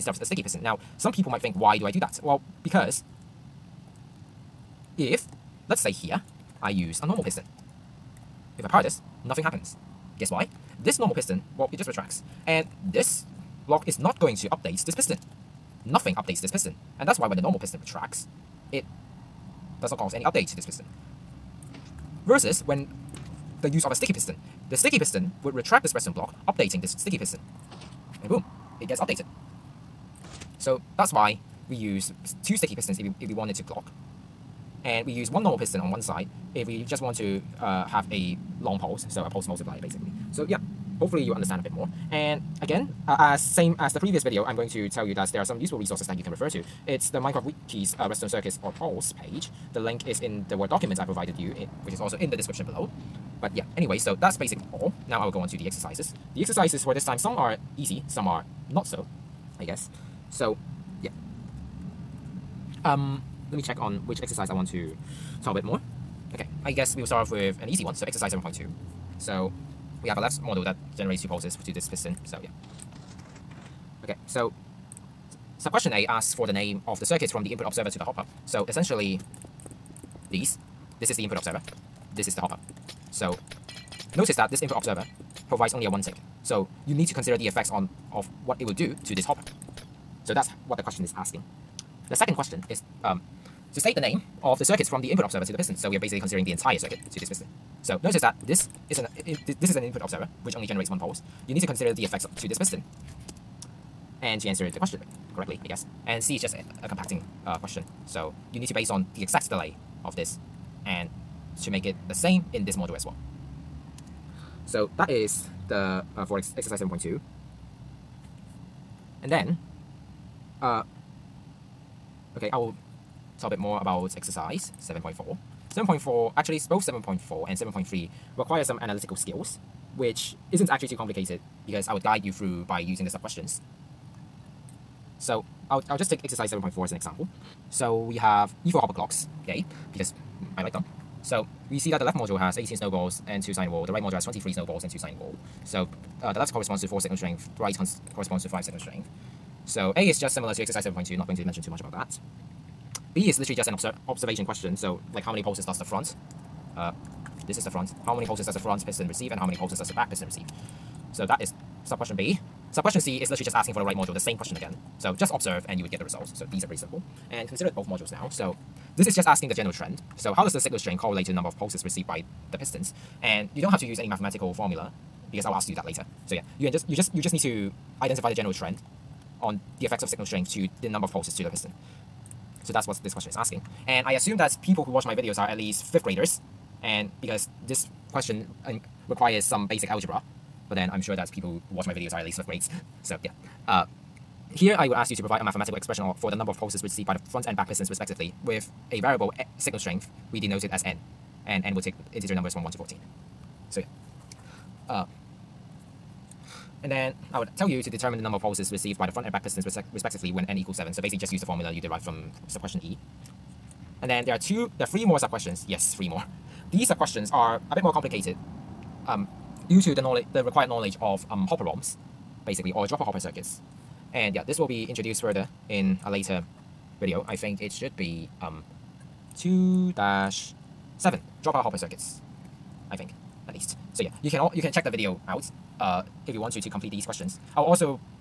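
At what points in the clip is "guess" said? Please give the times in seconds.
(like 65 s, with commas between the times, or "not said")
10 s, 59 s, 66 s, 105 s.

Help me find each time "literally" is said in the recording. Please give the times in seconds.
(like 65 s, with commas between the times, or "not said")
153 s, 163 s.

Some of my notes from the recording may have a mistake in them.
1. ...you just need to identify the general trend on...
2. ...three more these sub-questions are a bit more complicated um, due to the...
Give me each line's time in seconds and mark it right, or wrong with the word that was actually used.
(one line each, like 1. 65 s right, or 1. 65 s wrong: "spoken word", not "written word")
1. 177 s right
2. 215 s right.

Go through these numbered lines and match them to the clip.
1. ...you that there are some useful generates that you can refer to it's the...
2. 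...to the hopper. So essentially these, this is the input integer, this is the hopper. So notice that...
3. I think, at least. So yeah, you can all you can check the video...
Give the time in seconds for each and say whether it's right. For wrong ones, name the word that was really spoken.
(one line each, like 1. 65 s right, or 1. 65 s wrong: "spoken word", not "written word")
1. 45 s wrong: "resources", not "generates"
2. 77 s wrong: "observer", not "integer"
3. 232 s right.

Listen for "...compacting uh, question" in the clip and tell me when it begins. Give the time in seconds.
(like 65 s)
106 s.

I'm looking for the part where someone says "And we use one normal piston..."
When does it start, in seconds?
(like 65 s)
34 s.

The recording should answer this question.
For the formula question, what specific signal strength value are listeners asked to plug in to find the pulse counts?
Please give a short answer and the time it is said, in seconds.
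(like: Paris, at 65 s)
7, at 210 s.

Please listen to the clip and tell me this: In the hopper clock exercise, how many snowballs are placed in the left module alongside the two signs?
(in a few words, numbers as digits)
18.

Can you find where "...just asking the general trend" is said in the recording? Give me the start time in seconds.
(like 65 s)
169 s.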